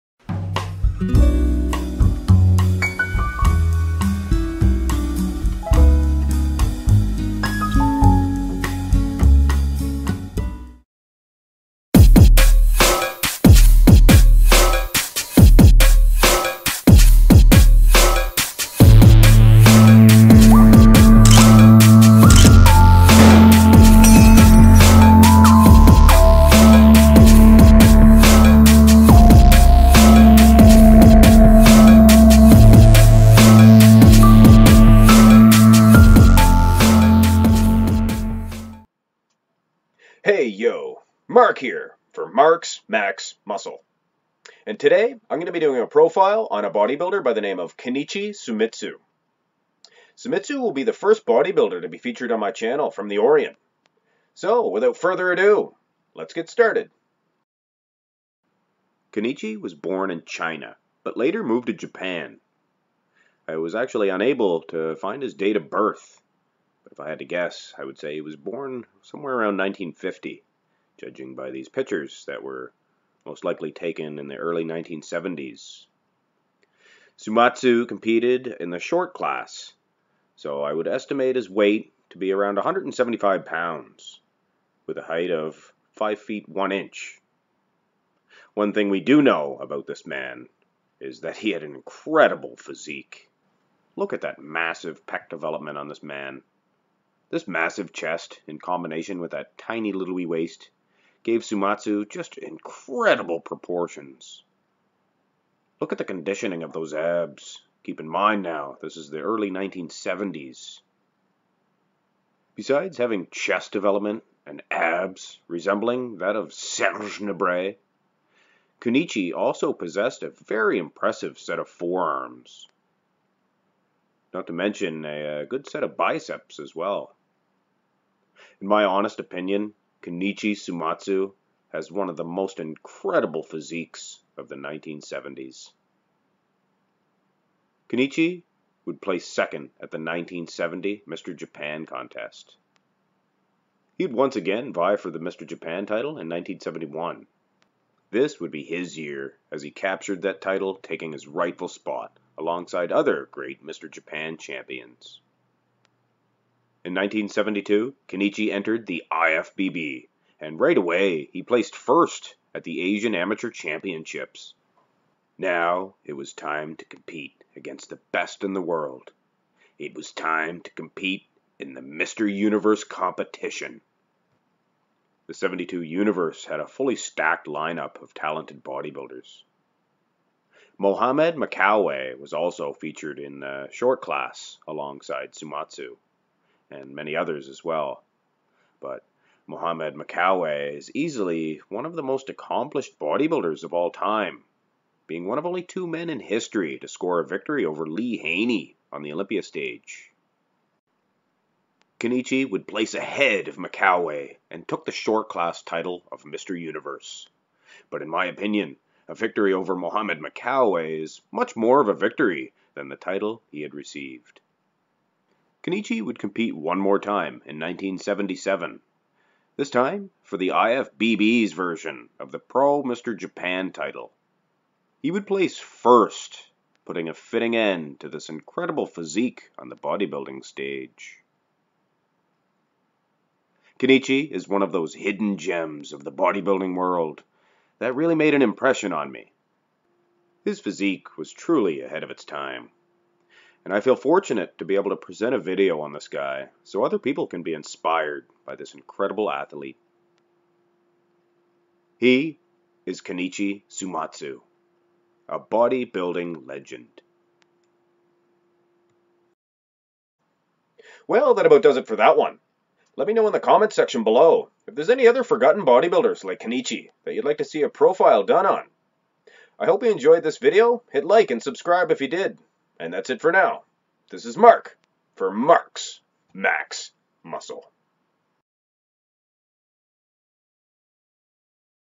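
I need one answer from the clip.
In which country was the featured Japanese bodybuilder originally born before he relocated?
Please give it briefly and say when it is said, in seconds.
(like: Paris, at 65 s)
China, at 60 s.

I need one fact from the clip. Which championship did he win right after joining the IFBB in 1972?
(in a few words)
Asian Amateur Championships.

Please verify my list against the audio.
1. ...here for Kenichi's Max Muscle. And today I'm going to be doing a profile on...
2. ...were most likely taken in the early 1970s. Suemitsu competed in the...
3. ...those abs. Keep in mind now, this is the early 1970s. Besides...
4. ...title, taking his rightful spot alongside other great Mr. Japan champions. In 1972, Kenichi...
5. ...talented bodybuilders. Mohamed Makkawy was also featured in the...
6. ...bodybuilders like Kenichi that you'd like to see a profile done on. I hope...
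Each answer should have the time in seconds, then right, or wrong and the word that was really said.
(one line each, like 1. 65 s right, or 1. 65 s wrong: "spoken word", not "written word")
1. 41 s wrong: "Mark", not "Kenichi"
2. 72 s right
3. 106 s right
4. 150 s right
5. 178 s right
6. 265 s right.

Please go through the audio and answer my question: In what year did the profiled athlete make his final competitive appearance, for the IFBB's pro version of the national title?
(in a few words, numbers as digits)
1977.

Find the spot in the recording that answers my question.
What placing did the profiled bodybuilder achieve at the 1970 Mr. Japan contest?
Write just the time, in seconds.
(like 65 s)
139 s.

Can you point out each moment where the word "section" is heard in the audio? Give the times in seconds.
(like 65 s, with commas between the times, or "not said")
263 s.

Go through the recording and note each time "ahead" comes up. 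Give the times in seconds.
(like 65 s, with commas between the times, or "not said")
202 s, 241 s.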